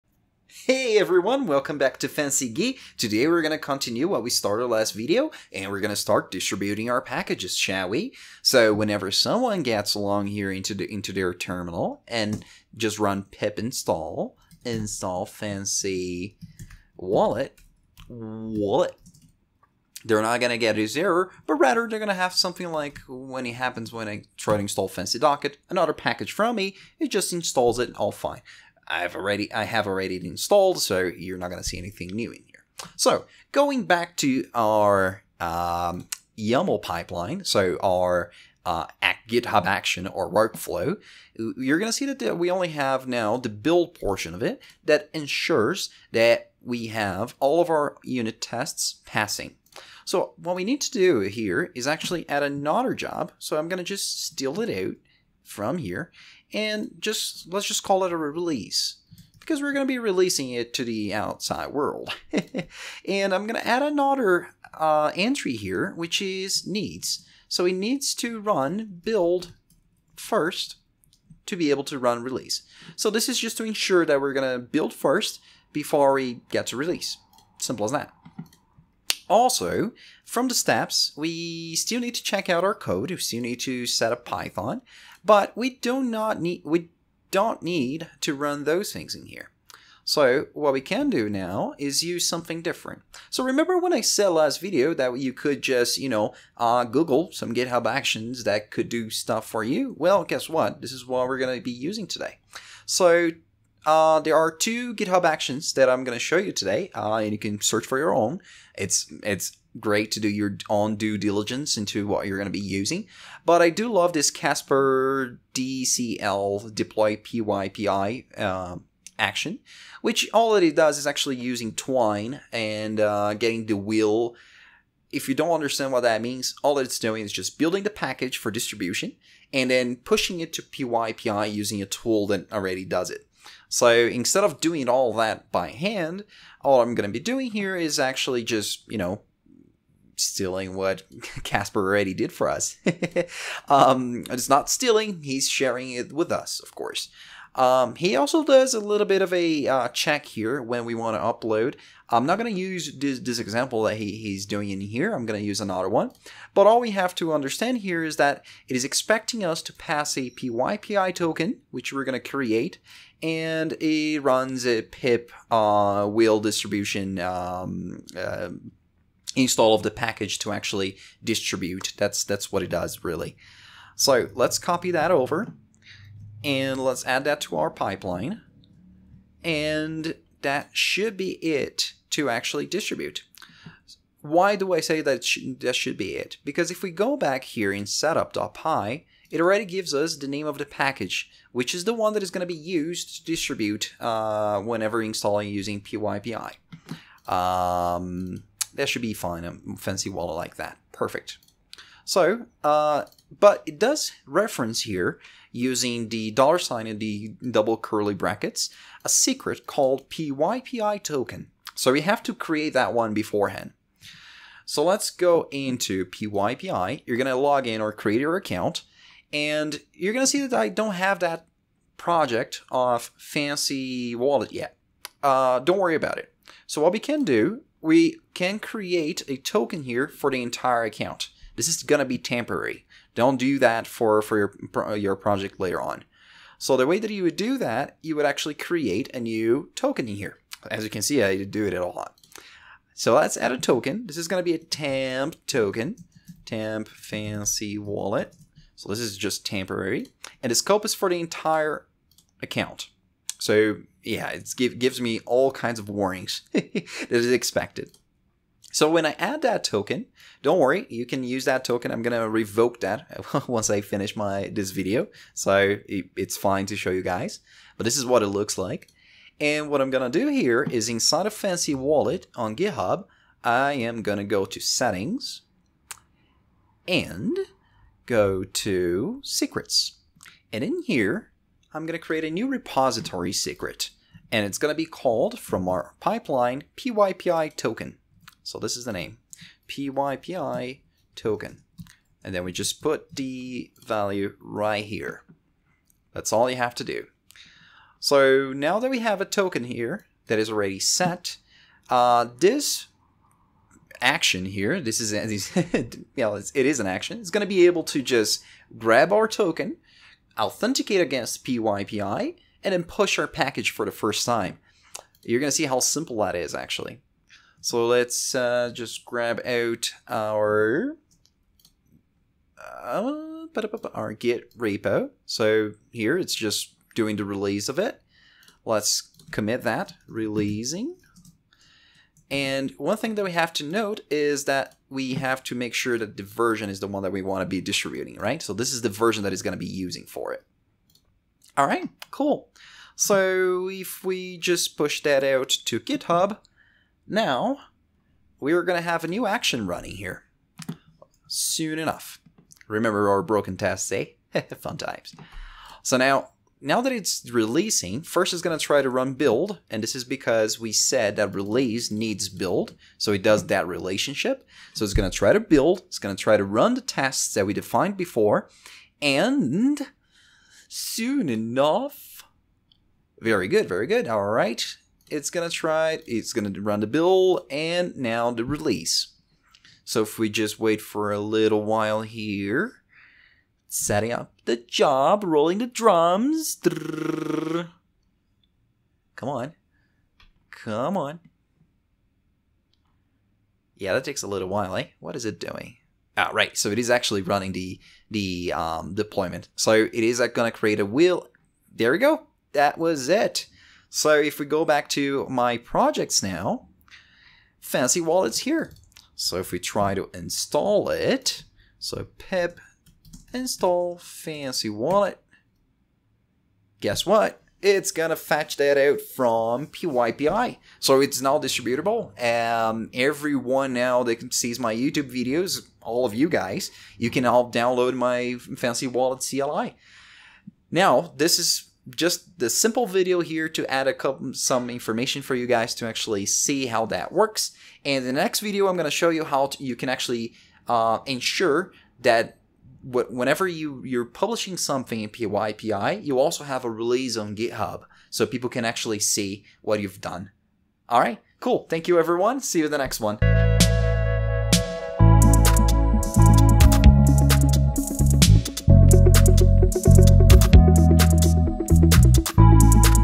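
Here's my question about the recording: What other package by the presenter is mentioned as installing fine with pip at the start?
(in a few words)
Fancy Docket.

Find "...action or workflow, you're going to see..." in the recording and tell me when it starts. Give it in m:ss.
0:39.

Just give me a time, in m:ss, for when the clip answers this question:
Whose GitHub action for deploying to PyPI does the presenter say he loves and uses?
1:54.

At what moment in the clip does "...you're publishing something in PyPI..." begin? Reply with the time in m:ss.
7:23.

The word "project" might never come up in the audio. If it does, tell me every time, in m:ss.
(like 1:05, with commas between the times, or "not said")
3:41, 3:55, 6:45.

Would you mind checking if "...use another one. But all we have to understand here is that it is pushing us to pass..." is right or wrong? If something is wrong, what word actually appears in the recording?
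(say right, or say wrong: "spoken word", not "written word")
wrong: "expecting", not "pushing".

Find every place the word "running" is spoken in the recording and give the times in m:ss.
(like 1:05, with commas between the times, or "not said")
5:49, 6:37.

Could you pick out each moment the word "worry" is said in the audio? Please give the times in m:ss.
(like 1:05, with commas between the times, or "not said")
3:45, 4:20.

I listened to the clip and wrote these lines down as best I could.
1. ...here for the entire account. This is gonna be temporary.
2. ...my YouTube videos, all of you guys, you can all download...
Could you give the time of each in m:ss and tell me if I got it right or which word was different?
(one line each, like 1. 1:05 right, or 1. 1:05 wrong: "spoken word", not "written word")
1. 3:49 right
2. 7:04 right.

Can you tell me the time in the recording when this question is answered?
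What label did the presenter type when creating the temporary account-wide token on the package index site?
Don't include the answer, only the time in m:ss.
4:06.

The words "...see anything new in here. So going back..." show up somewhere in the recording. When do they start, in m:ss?
0:31.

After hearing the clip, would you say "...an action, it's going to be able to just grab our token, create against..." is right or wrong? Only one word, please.
wrong.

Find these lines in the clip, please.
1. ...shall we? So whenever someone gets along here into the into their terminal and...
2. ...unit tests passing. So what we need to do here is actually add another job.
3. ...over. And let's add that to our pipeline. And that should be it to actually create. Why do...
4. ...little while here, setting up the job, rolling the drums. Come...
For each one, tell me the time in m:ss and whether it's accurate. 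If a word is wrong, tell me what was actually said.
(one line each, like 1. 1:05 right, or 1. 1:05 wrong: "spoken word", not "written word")
1. 0:07 right
2. 0:48 right
3. 2:55 wrong: "distribute", not "create"
4. 6:21 right.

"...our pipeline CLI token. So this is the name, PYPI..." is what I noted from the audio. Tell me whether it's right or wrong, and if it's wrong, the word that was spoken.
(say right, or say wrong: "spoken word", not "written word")
wrong: "PYPI", not "CLI".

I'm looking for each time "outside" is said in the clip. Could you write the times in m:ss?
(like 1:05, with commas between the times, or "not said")
1:01.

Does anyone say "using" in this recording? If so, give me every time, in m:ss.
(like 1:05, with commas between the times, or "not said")
1:41, 1:52, 2:01, 2:11, 3:15, 3:25, 5:39.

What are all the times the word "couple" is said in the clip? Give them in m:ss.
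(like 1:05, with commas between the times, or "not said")
7:13.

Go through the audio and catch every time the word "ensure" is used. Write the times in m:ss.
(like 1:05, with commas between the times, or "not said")
0:45, 1:13, 7:21.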